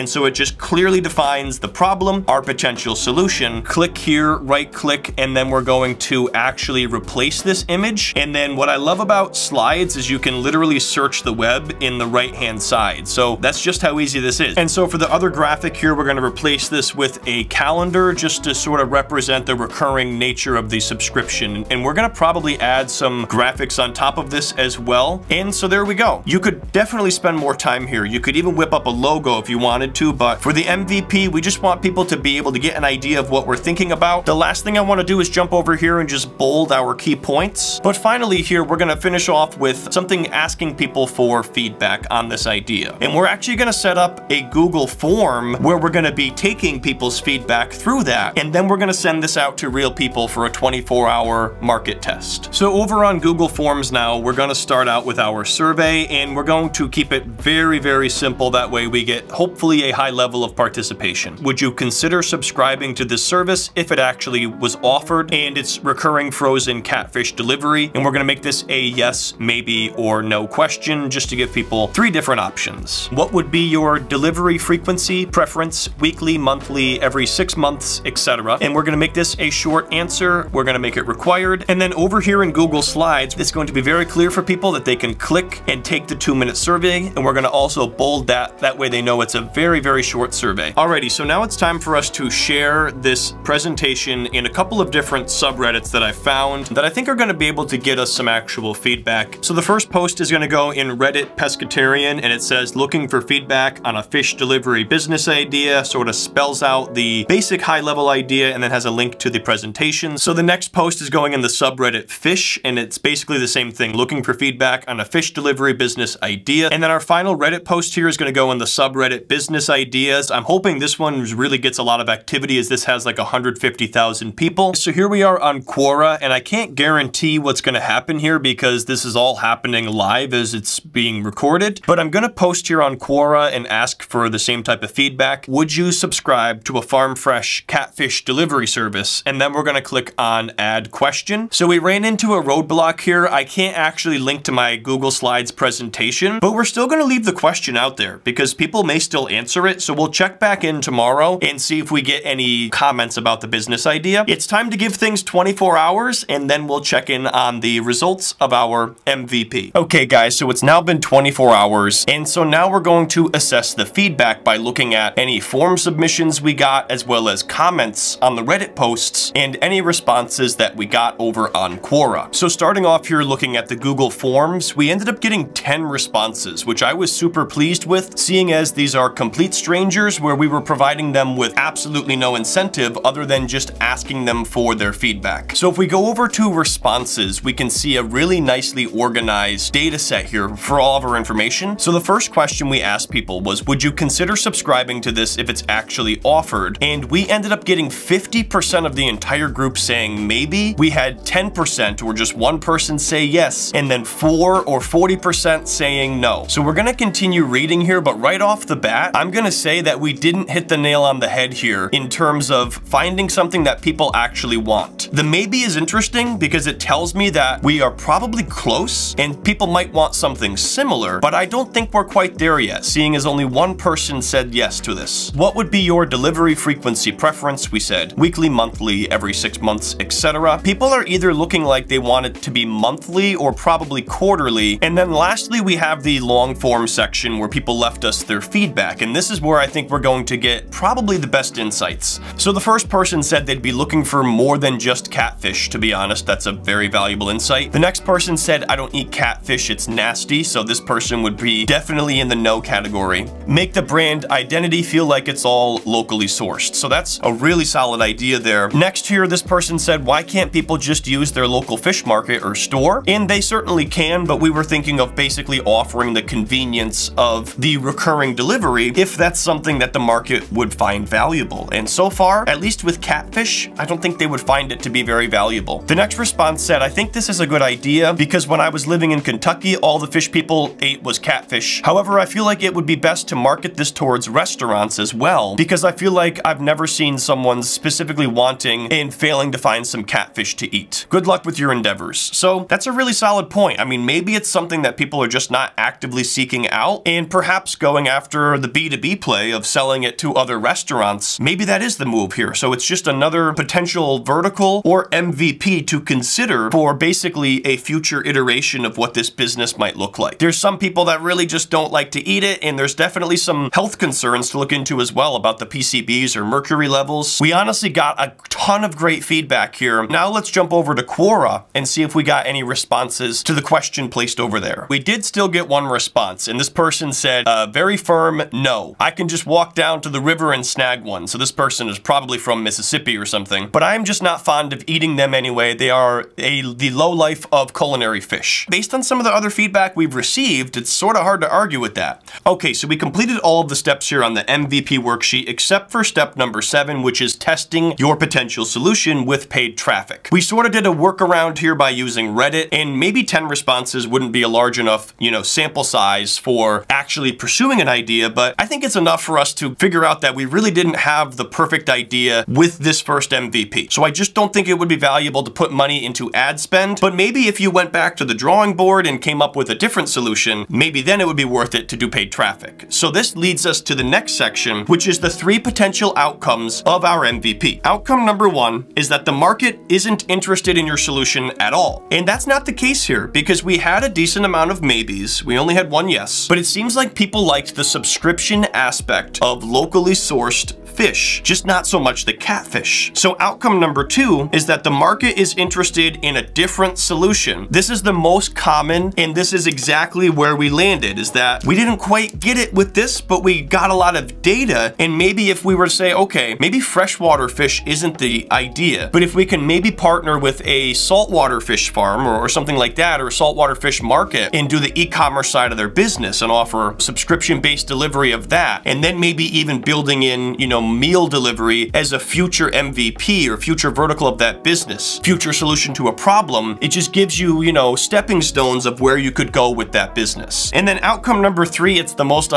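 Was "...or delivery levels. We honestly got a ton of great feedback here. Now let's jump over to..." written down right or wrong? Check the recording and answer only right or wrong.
wrong.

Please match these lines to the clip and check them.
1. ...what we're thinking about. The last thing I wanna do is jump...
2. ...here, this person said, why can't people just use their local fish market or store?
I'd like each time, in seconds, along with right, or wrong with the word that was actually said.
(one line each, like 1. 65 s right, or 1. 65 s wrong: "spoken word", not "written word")
1. 33 s right
2. 259 s right.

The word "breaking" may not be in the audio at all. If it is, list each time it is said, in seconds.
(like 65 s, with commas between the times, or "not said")
not said.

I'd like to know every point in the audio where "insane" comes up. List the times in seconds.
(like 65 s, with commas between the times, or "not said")
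not said.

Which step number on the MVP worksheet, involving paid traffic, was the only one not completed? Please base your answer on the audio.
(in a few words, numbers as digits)
7.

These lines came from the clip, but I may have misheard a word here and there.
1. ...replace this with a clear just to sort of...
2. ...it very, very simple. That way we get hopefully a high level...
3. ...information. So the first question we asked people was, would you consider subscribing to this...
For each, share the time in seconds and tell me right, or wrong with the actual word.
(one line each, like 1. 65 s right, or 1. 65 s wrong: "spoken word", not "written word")
1. 16 s wrong: "calendar", not "clear"
2. 57 s right
3. 191 s right.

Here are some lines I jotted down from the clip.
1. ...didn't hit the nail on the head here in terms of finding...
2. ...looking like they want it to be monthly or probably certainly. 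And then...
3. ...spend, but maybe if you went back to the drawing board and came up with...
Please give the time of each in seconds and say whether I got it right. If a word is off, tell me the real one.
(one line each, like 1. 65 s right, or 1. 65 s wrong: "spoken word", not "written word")
1. 210 s right
2. 231 s wrong: "quarterly", not "certainly"
3. 366 s right.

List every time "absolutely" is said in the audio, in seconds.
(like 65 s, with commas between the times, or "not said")
181 s.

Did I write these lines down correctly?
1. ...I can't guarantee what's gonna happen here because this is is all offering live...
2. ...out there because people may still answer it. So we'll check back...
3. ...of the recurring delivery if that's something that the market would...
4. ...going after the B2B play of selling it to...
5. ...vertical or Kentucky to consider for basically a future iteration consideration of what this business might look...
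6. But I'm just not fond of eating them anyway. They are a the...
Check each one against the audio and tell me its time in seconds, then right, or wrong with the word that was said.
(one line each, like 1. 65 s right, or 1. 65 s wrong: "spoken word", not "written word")
1. 126 s wrong: "happening", not "offering"
2. 147 s right
3. 267 s right
4. 297 s right
5. 304 s wrong: "MVP", not "Kentucky"
6. 333 s right.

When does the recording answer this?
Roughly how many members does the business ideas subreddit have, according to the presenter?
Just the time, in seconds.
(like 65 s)
123 s.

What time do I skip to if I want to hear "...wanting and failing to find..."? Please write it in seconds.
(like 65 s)
288 s.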